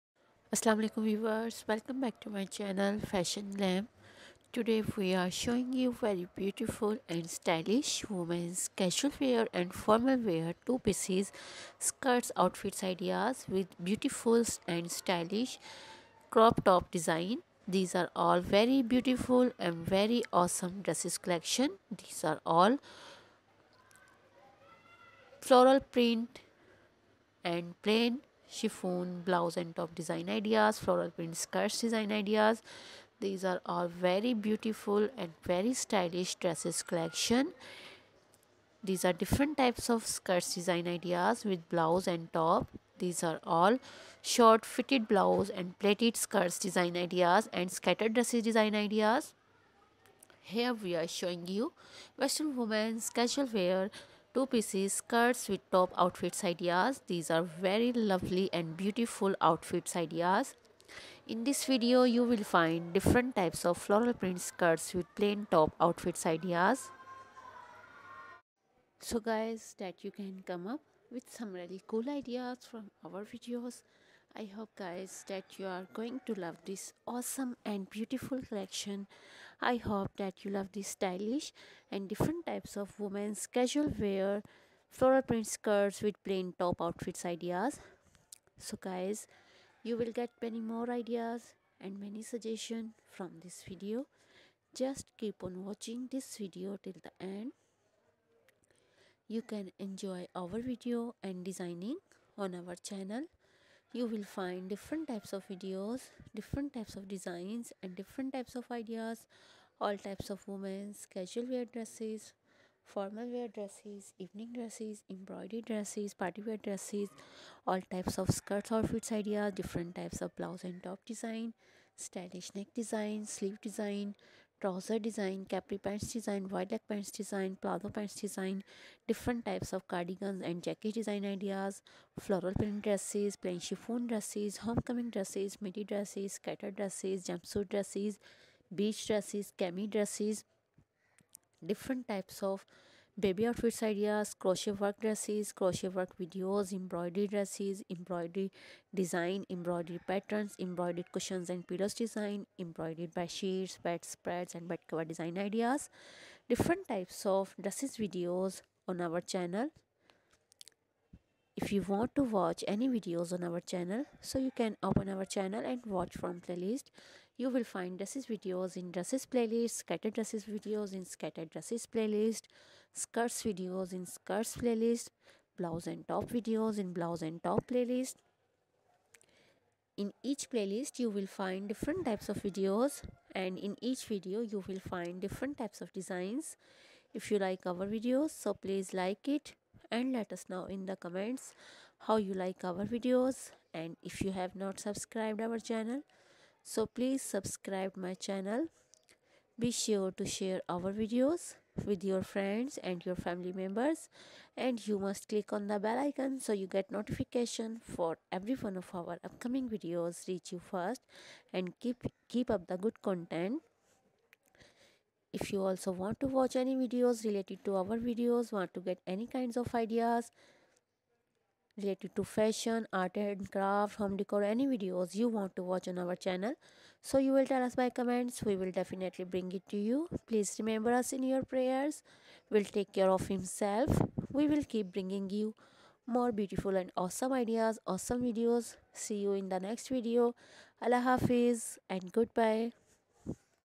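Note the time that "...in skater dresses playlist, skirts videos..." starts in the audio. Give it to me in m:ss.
2:50.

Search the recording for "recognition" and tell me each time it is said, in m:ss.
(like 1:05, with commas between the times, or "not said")
not said.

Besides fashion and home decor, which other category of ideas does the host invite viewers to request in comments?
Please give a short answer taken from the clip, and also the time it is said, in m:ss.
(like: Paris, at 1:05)
art and craft, at 3:42.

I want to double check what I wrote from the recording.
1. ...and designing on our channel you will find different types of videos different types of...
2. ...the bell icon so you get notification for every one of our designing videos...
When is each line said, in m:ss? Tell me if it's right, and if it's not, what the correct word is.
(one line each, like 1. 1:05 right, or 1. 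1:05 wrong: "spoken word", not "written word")
1. 1:41 right
2. 3:25 wrong: "upcoming", not "designing".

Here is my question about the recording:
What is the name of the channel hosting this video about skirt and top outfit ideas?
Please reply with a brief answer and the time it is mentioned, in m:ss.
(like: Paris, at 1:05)
Fashion Glam, at 0:03.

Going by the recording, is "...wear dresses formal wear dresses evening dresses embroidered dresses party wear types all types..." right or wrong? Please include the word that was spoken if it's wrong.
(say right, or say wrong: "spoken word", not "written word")
wrong: "dresses", not "types".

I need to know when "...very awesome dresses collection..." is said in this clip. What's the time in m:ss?
0:19.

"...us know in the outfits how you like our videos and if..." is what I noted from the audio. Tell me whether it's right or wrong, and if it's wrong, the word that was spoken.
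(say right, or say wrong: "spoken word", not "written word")
wrong: "comments", not "outfits".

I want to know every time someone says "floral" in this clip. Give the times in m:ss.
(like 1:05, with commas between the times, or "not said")
0:25, 0:30, 1:03, 1:24, 2:12.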